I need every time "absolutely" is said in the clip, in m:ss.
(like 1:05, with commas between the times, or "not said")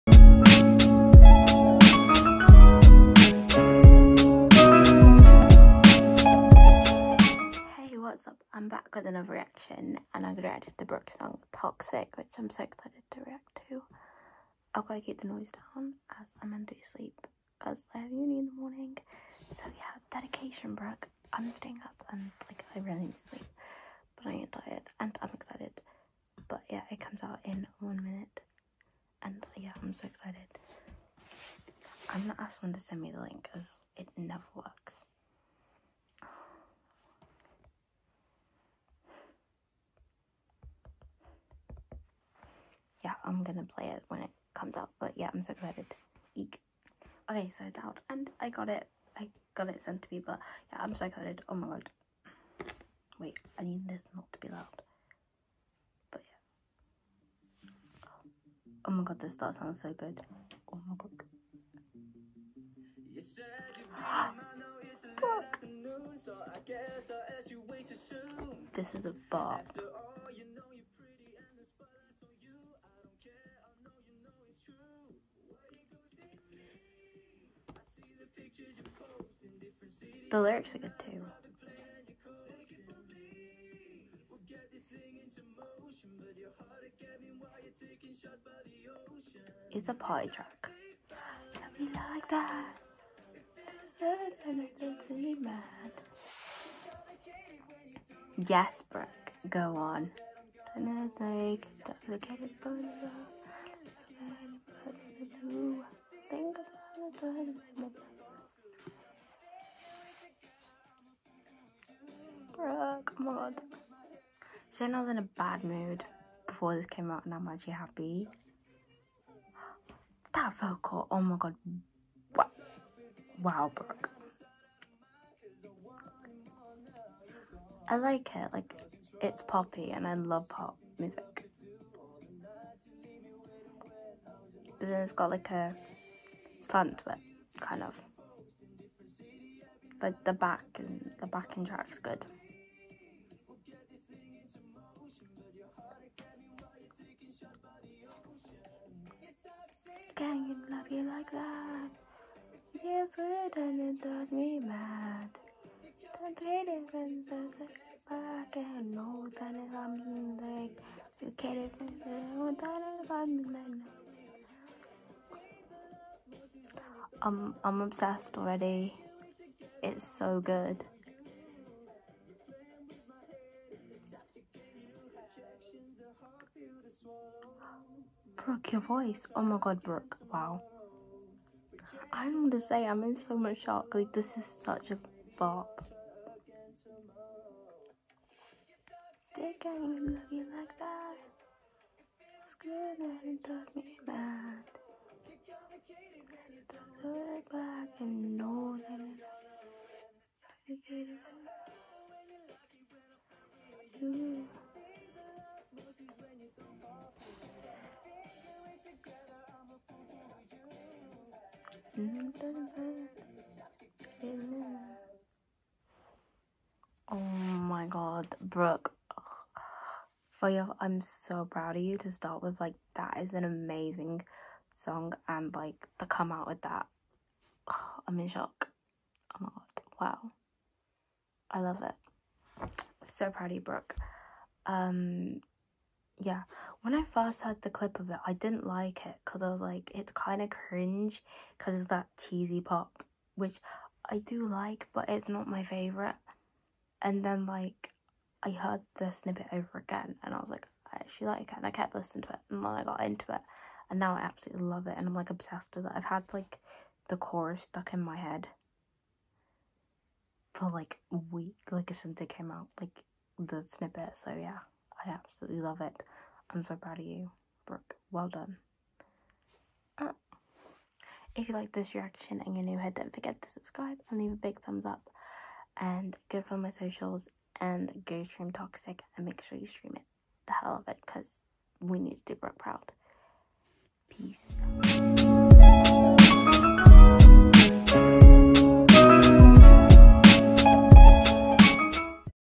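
4:14, 4:25.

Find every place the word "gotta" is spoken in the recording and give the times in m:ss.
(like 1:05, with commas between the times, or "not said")
0:14.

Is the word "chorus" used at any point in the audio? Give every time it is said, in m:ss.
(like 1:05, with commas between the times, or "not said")
4:17.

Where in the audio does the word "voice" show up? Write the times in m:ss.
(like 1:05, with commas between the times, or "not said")
2:58.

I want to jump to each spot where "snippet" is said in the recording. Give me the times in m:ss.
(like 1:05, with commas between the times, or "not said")
4:09, 4:23.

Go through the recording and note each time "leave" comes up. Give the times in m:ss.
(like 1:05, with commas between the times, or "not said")
4:34.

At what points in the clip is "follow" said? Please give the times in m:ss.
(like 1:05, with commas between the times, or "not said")
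4:36.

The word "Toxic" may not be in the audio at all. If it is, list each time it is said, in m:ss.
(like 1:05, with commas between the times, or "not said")
0:11, 4:38.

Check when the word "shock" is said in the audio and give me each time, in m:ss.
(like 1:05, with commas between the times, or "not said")
3:03, 3:48.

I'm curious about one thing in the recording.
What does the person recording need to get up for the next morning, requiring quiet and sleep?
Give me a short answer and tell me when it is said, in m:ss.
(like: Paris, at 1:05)
Uni, at 0:18.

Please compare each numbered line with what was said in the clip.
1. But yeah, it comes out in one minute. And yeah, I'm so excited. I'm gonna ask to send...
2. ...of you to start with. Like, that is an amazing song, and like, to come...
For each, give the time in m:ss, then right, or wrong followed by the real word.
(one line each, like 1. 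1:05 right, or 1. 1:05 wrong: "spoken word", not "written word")
1. 0:26 right
2. 3:41 right.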